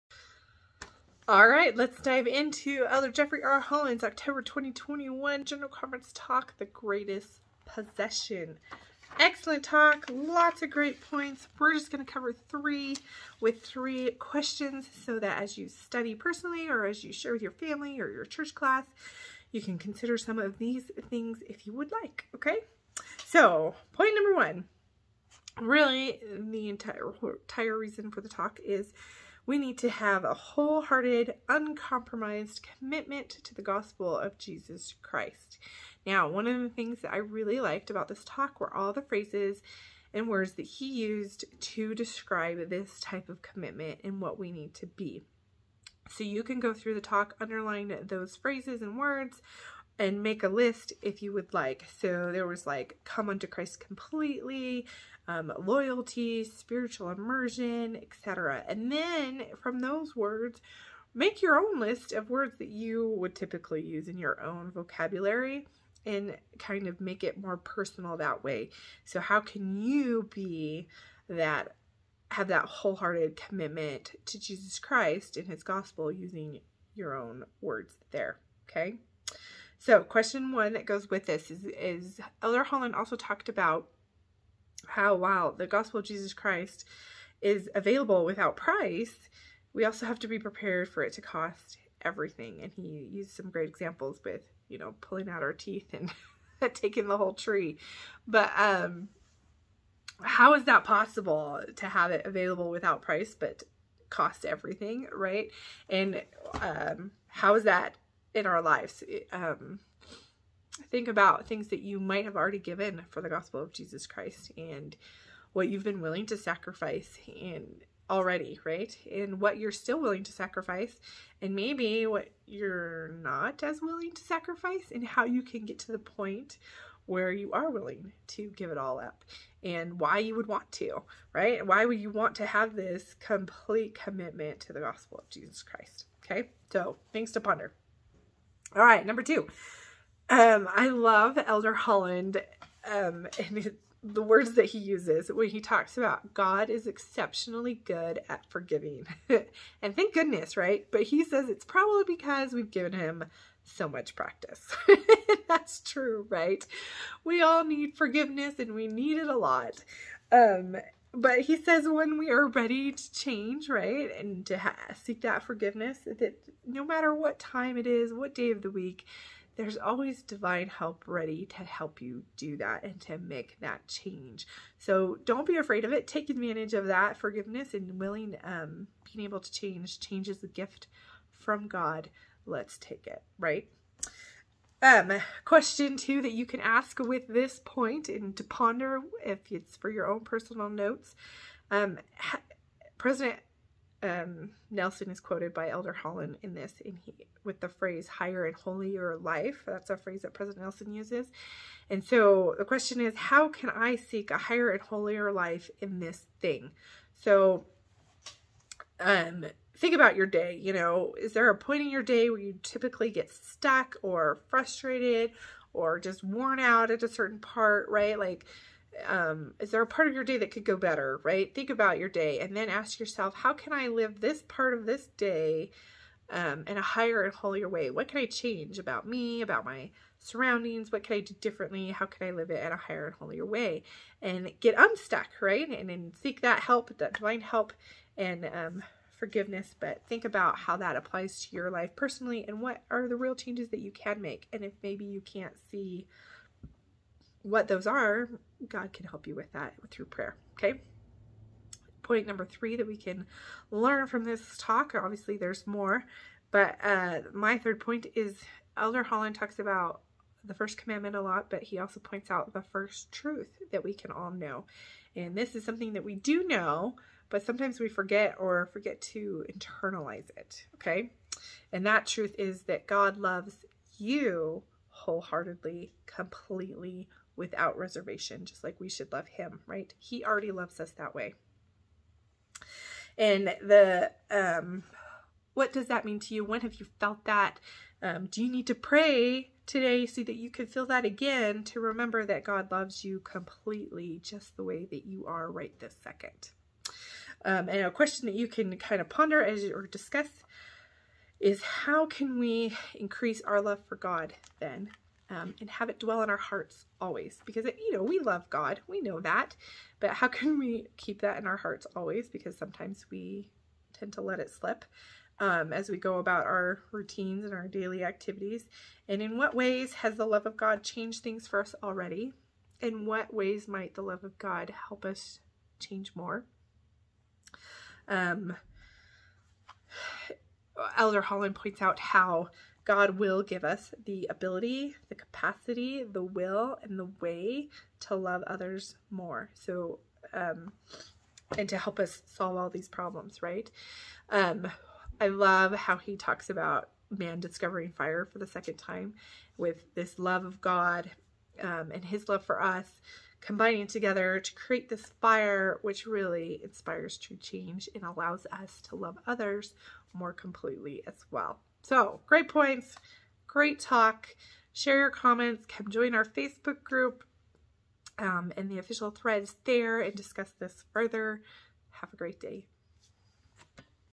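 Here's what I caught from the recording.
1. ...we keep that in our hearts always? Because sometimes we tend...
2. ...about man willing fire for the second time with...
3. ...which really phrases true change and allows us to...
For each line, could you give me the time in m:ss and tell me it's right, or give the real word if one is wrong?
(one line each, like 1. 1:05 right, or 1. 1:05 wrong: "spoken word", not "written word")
1. 5:10 right
2. 5:46 wrong: "discovering", not "willing"
3. 5:55 wrong: "inspires", not "phrases".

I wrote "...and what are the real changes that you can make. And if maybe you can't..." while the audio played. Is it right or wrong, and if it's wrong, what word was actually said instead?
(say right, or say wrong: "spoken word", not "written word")
right.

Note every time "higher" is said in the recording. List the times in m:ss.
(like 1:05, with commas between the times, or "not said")
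3:18, 3:24, 3:46, 3:52.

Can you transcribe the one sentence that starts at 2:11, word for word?
Why would you want to have this complete commitment to the gospel of Jesus Christ?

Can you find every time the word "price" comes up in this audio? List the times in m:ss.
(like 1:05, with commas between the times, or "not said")
1:28, 1:43.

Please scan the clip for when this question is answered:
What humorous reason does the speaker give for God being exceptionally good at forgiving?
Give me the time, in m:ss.
2:32.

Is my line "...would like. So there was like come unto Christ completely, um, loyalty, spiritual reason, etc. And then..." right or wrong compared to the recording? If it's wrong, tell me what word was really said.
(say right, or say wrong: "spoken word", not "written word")
wrong: "immersion", not "reason".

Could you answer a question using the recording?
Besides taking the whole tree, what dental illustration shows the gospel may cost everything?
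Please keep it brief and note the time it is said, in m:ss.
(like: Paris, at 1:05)
pulling out our teeth, at 1:35.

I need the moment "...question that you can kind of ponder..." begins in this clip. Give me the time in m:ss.
4:57.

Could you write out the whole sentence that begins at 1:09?
So how can you be that have that wholehearted commitment to Jesus Christ and his gospel using your own words there, okay?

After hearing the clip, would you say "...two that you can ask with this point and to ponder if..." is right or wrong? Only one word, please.
right.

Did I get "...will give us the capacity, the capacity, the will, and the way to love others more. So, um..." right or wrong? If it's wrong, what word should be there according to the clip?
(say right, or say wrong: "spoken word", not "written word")
wrong: "ability", not "capacity".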